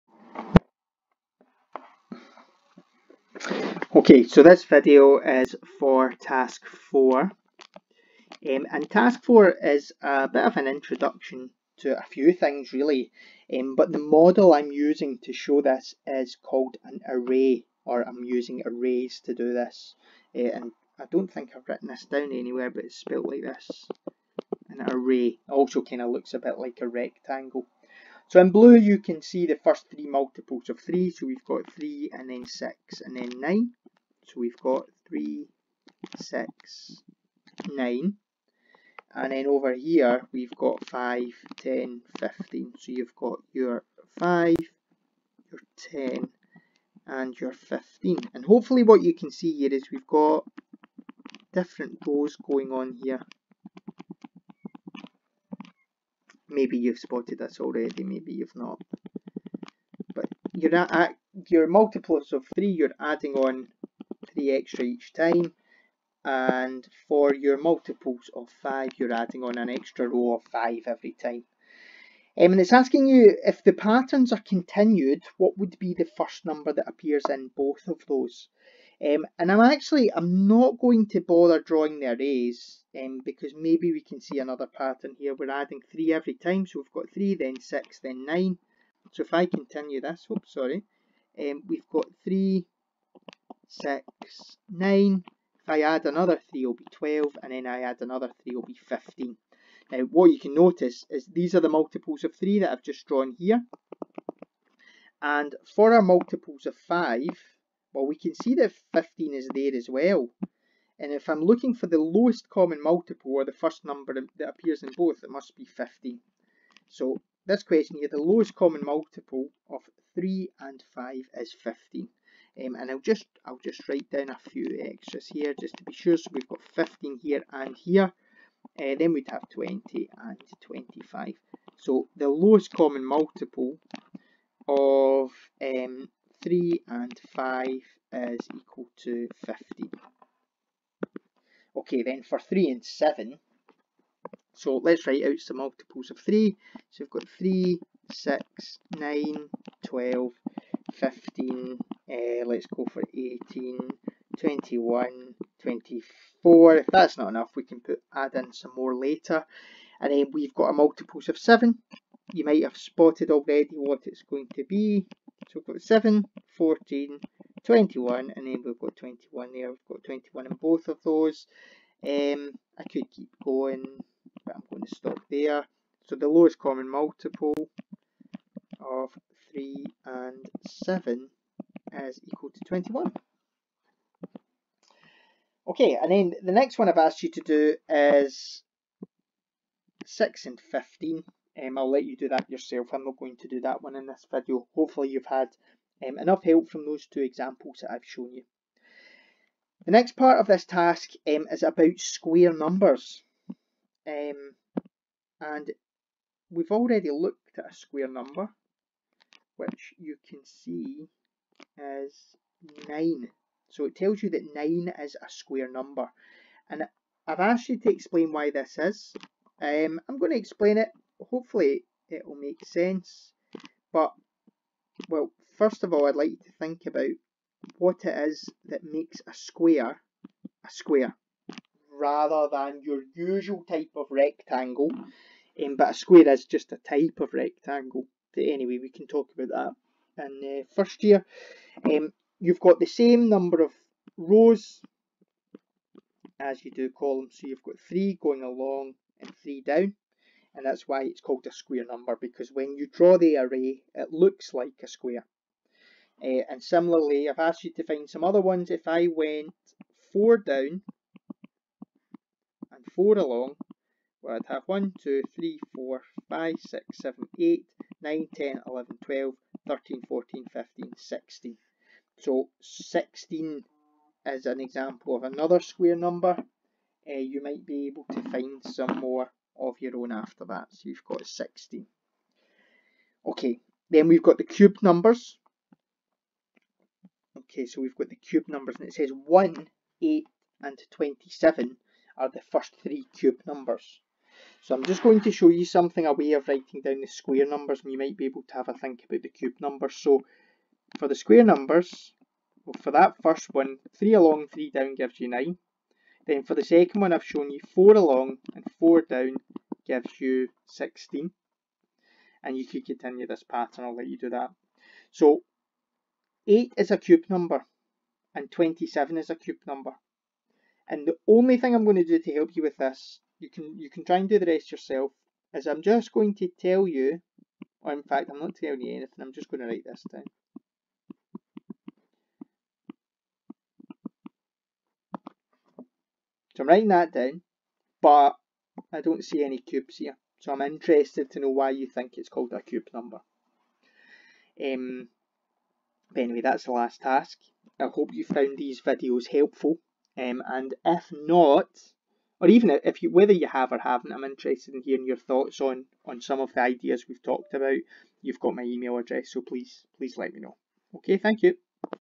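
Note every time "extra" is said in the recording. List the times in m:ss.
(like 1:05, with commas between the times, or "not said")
1:04, 1:09, 2:04.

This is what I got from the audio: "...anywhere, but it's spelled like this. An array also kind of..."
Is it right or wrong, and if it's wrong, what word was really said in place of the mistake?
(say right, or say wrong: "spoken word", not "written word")
right.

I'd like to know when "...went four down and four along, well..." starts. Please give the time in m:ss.
4:19.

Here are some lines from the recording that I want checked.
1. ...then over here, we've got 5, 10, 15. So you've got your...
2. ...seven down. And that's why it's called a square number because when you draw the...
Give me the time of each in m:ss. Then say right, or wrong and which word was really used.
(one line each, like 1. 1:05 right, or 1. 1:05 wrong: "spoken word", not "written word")
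1. 0:39 right
2. 4:09 wrong: "three", not "seven".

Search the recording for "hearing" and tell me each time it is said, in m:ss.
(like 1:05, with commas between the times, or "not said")
5:54.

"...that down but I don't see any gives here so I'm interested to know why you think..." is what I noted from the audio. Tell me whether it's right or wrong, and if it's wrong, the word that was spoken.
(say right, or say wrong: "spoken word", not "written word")
wrong: "cubes", not "gives".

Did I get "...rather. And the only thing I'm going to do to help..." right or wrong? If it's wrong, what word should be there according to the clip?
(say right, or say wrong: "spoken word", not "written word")
wrong: "number", not "rather".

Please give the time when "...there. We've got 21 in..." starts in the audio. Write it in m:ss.
2:49.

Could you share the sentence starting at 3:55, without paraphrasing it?
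Um, but a square is just a type of rectangle.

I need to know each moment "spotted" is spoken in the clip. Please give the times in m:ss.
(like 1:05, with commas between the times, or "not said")
0:56, 2:42.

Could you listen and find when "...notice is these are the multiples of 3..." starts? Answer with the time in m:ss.
1:40.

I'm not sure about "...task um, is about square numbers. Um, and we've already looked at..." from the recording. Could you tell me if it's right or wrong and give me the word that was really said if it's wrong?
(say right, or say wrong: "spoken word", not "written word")
right.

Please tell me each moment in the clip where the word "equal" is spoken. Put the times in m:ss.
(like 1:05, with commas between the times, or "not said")
2:18, 3:02.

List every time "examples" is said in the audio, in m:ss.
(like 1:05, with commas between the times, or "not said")
3:17, 4:34.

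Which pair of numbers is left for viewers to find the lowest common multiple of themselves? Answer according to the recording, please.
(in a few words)
6 and 15.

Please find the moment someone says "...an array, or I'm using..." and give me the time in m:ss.
0:16.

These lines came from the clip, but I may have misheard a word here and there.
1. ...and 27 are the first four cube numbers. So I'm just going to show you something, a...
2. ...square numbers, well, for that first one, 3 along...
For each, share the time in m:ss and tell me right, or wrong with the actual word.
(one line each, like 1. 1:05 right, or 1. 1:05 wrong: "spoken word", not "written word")
1. 4:50 wrong: "three", not "four"
2. 5:01 right.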